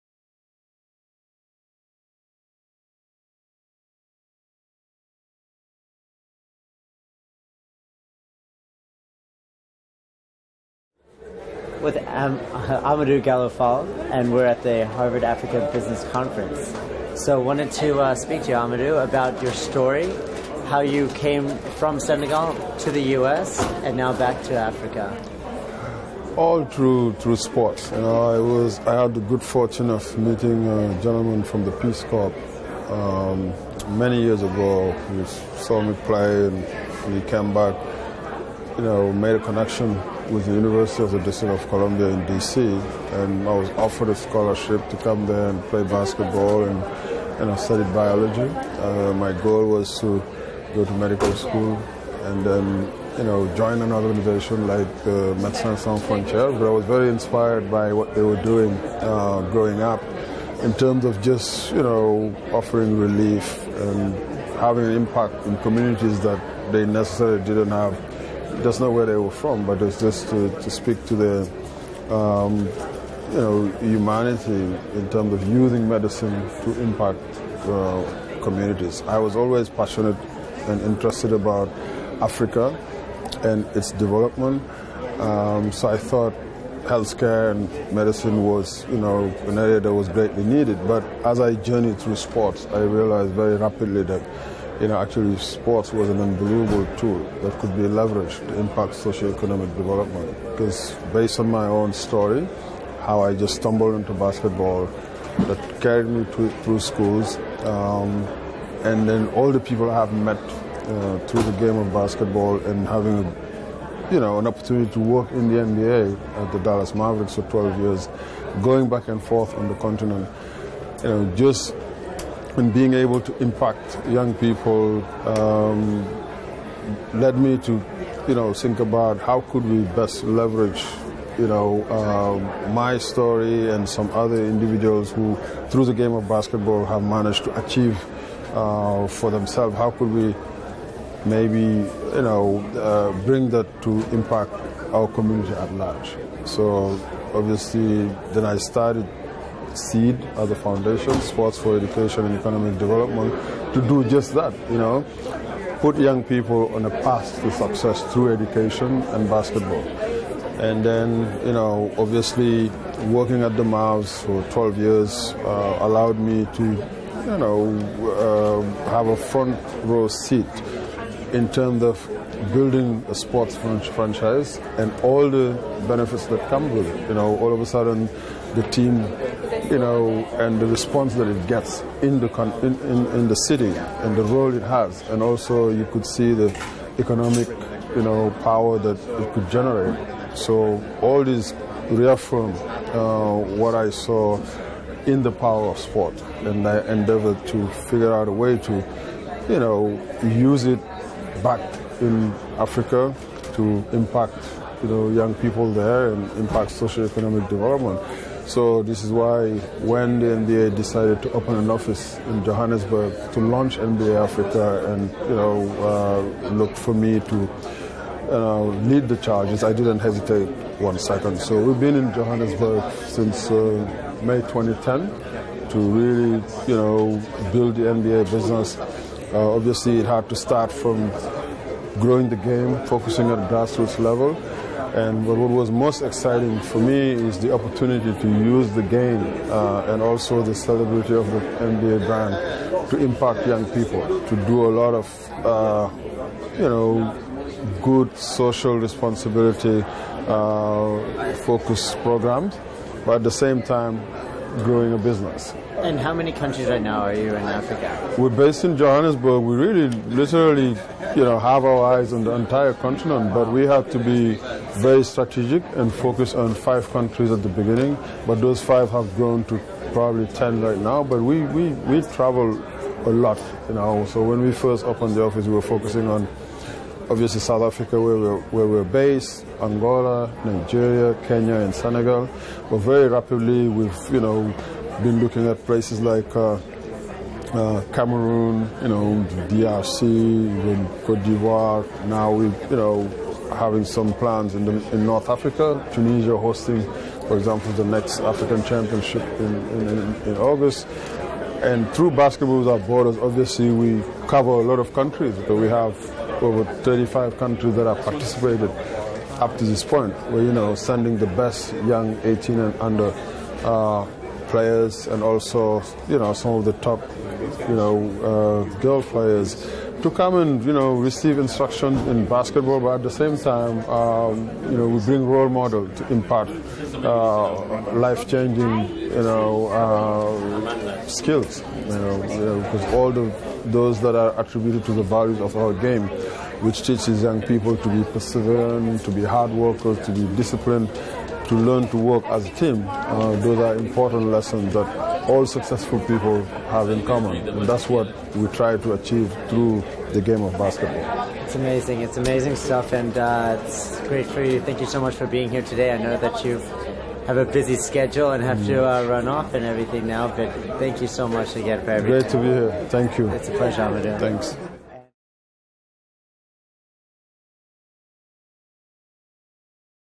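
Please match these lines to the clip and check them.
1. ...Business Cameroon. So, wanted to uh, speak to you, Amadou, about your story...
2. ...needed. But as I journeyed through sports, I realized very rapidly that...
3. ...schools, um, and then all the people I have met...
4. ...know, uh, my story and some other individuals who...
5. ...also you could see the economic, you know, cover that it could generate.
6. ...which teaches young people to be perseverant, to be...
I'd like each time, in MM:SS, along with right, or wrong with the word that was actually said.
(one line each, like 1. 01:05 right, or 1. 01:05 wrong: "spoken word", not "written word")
1. 00:15 wrong: "Conference", not "Cameroon"
2. 01:30 right
3. 01:46 right
4. 02:11 right
5. 03:05 wrong: "power", not "cover"
6. 05:36 right.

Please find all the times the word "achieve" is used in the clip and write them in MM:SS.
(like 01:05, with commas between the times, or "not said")
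02:17, 05:48.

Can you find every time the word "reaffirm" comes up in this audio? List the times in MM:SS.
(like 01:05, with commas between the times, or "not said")
03:11.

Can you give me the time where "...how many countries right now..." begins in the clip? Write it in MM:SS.
04:15.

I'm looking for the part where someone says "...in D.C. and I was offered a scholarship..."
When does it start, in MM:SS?
00:42.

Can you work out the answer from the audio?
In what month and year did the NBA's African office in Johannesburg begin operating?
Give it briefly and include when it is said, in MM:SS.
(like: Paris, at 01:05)
May 2010, at 03:44.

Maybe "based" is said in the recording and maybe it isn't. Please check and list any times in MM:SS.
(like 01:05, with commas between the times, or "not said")
01:41, 04:18, 04:38.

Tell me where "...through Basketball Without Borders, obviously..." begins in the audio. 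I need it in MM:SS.
05:01.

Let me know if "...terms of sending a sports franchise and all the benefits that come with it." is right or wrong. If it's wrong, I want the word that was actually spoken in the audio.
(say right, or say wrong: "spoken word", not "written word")
wrong: "building", not "sending".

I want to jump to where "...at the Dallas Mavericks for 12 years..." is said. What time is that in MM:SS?
01:56.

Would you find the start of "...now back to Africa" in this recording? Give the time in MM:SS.
00:23.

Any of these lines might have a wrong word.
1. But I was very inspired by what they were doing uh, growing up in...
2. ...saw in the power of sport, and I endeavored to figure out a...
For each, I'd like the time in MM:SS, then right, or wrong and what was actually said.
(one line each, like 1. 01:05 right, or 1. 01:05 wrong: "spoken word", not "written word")
1. 00:56 right
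2. 03:13 right.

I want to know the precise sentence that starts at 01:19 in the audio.
I was always passionate and interested about Africa and its development.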